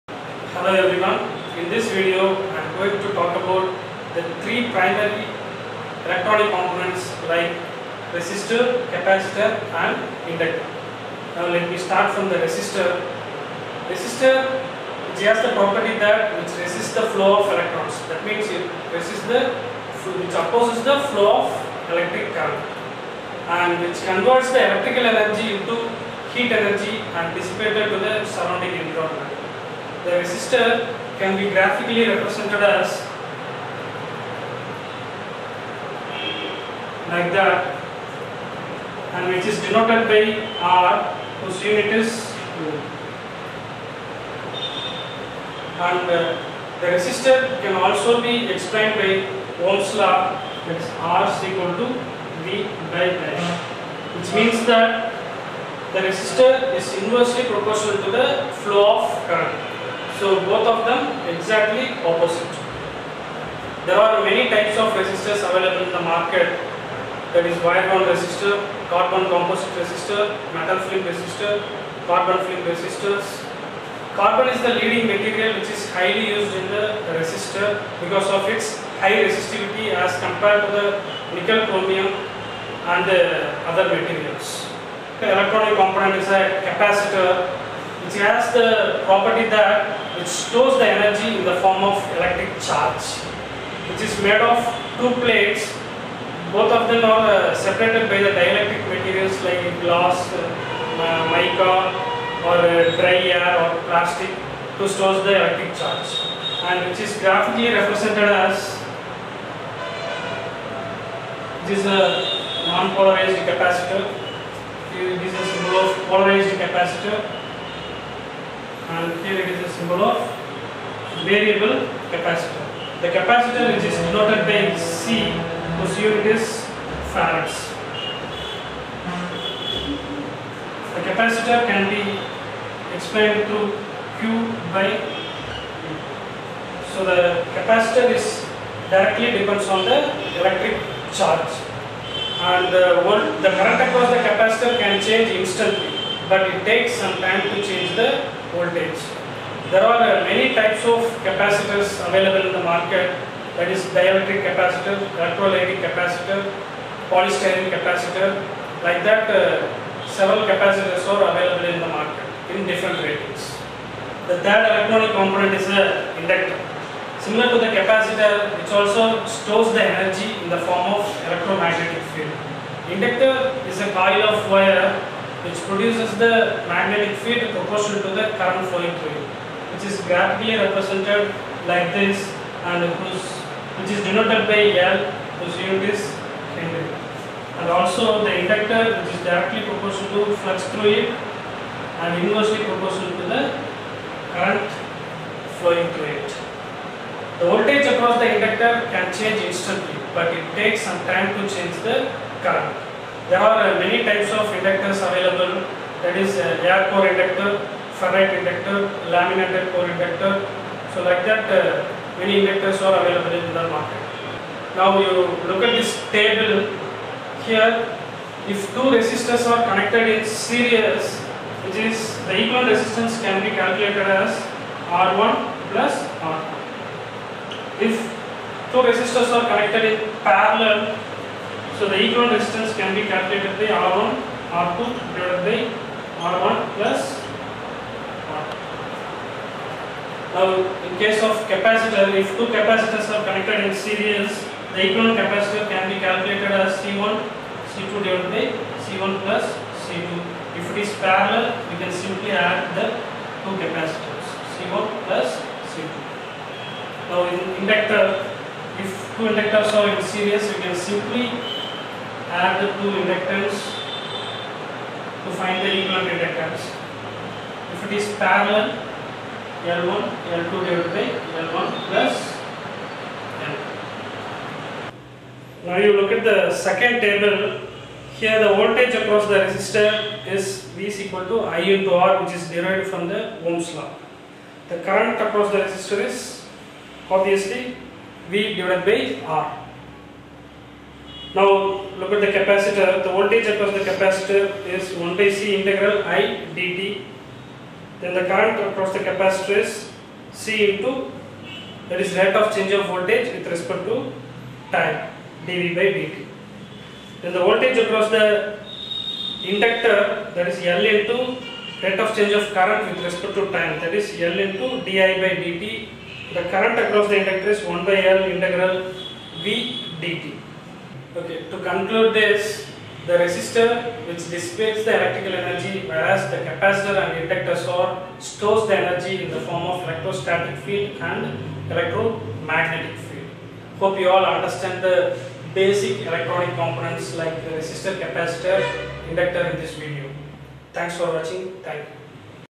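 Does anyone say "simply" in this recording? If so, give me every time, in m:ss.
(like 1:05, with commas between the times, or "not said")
4:11, 4:20.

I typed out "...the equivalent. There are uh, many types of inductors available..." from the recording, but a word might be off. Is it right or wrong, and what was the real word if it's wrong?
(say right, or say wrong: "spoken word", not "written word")
wrong: "current", not "equivalent".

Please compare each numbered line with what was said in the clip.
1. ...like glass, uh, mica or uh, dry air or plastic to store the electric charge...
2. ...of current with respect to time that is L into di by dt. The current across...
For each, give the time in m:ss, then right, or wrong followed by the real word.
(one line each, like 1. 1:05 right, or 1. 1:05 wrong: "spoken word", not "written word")
1. 1:39 right
2. 5:12 right.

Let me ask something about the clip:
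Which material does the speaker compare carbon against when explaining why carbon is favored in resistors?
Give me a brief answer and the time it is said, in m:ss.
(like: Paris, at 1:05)
Nickel chromium, at 1:21.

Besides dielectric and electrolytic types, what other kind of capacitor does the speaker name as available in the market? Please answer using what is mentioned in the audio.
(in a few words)
Polystyrene capacitor.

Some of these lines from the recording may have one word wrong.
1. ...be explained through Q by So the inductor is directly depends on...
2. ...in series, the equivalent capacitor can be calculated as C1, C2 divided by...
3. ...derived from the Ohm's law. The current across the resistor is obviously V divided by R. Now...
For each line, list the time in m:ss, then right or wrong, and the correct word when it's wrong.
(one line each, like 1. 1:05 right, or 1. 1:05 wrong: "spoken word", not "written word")
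1. 2:11 wrong: "capacitor", not "inductor"
2. 4:03 right
3. 4:42 right.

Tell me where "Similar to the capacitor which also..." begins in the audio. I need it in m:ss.
2:47.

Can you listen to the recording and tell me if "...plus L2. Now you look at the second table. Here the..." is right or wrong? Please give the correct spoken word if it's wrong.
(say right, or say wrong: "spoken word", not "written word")
right.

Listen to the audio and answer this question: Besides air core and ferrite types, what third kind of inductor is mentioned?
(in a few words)
Laminated core inductor.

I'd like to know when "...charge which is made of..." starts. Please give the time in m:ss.
1:32.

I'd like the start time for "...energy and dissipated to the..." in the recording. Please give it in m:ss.
0:26.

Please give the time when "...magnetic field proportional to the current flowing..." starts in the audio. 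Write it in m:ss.
2:56.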